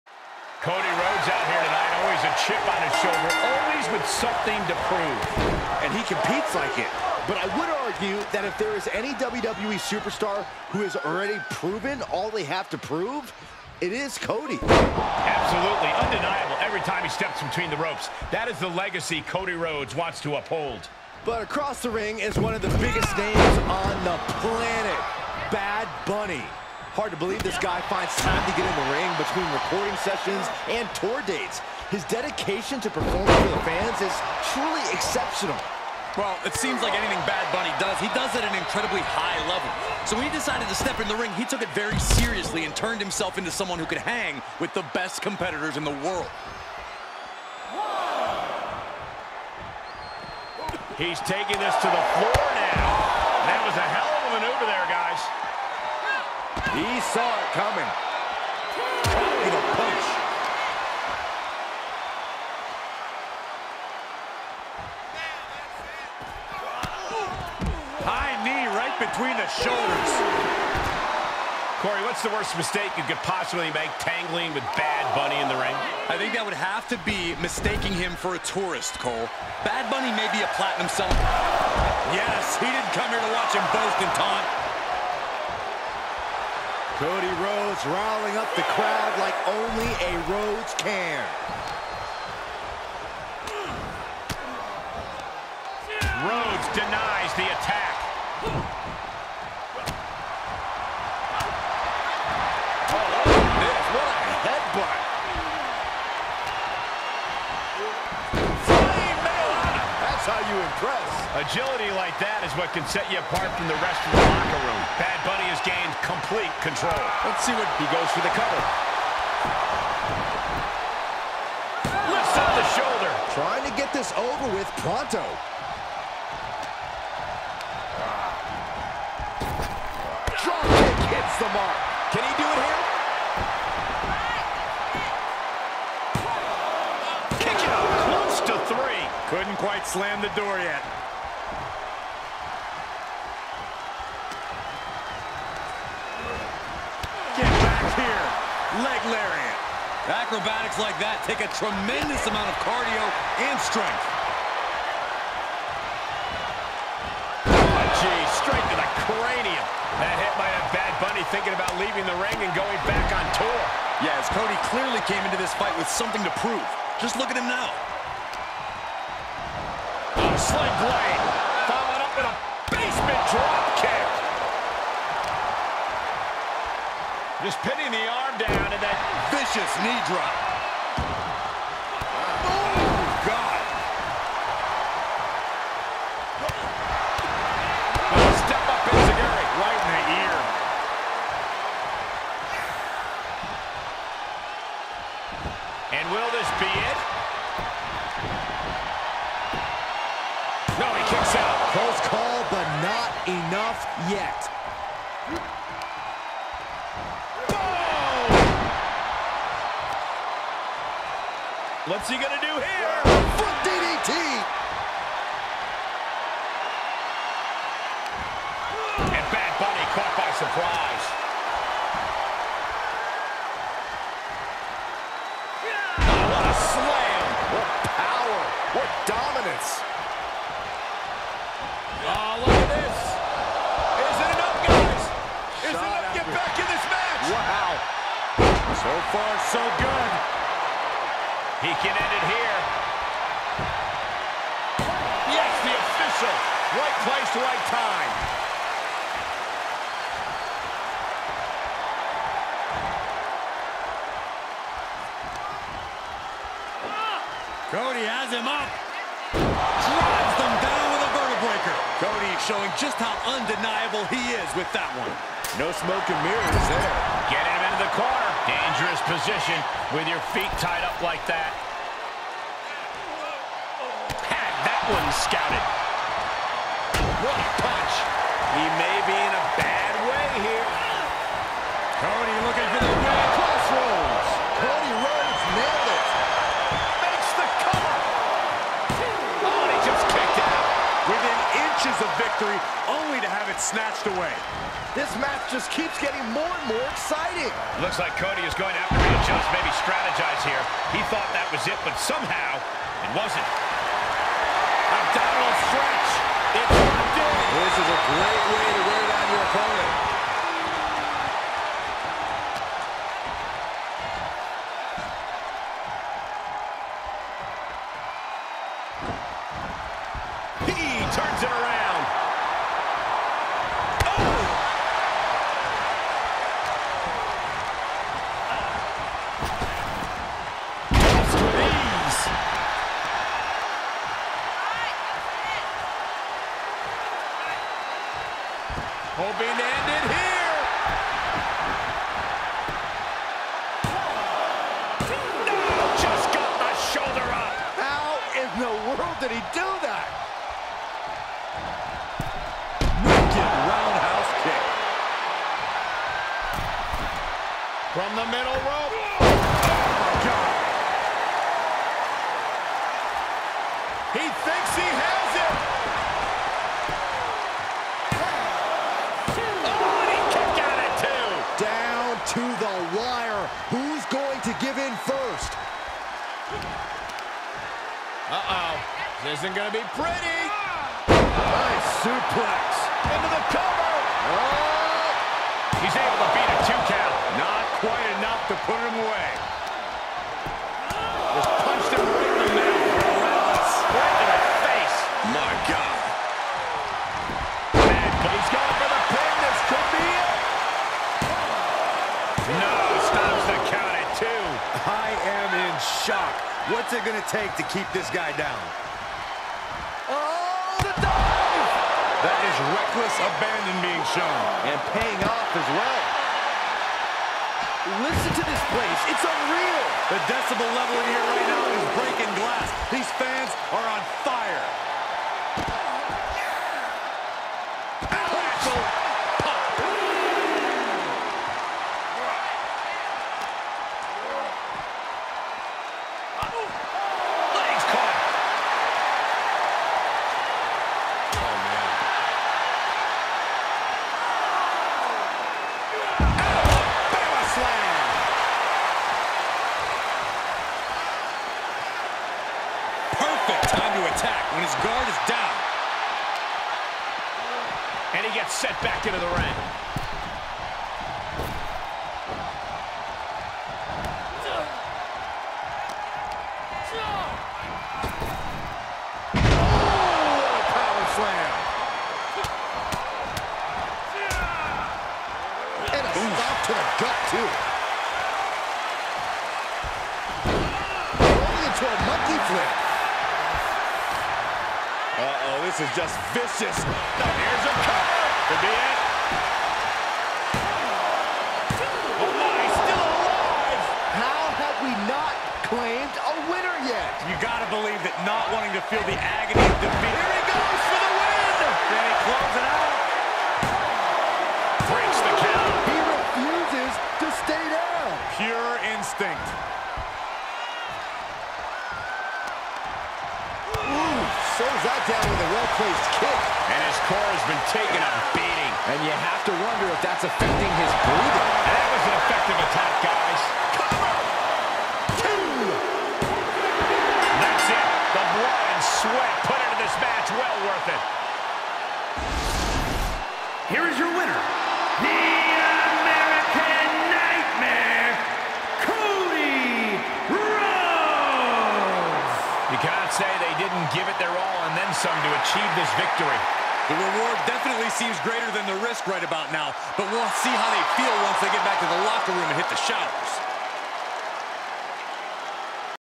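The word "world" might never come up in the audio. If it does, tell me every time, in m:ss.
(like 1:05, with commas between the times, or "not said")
0:46, 5:48.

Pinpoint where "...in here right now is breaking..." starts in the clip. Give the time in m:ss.
7:01.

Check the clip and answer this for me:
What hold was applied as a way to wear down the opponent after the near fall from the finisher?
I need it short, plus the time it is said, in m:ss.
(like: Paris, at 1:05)
Abdominal stretch, at 5:04.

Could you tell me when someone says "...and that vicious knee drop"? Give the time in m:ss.
2:58.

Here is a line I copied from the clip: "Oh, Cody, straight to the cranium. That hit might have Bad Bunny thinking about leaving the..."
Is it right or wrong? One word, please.
wrong.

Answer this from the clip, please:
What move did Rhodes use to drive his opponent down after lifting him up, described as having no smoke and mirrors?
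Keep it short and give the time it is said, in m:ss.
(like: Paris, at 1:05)
Vertebreaker, at 4:21.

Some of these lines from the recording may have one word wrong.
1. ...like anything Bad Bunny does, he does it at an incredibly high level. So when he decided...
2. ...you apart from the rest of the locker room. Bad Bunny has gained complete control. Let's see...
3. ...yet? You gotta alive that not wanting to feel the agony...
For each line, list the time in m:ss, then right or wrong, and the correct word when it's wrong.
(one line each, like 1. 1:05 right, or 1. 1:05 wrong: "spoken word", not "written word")
1. 0:36 right
2. 1:53 right
3. 8:16 wrong: "believe", not "alive".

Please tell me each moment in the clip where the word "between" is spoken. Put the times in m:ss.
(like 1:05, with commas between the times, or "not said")
0:17, 0:29, 1:09.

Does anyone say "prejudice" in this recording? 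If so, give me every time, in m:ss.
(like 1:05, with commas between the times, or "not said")
not said.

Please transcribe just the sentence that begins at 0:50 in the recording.
He's taking this to the floor.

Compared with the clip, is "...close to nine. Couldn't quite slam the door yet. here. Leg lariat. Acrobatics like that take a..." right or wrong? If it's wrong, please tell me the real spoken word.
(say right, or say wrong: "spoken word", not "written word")
wrong: "three", not "nine".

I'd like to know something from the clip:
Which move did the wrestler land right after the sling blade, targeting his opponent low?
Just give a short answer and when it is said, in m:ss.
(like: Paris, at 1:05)
Basement drop kick, at 2:52.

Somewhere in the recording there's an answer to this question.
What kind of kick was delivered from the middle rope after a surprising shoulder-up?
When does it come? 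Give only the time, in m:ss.
5:53.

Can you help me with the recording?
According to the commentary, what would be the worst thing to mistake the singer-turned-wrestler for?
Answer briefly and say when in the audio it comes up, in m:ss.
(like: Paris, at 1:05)
A tourist, at 1:18.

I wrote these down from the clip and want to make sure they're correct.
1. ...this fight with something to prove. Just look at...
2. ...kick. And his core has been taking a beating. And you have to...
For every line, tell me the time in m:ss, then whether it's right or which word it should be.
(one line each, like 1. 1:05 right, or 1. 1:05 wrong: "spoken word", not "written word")
1. 2:45 right
2. 8:36 right.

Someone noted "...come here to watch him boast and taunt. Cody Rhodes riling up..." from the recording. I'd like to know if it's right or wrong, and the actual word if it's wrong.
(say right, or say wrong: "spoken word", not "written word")
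right.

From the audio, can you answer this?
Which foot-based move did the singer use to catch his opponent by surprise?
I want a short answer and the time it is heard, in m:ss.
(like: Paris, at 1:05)
Foot DDT, at 3:33.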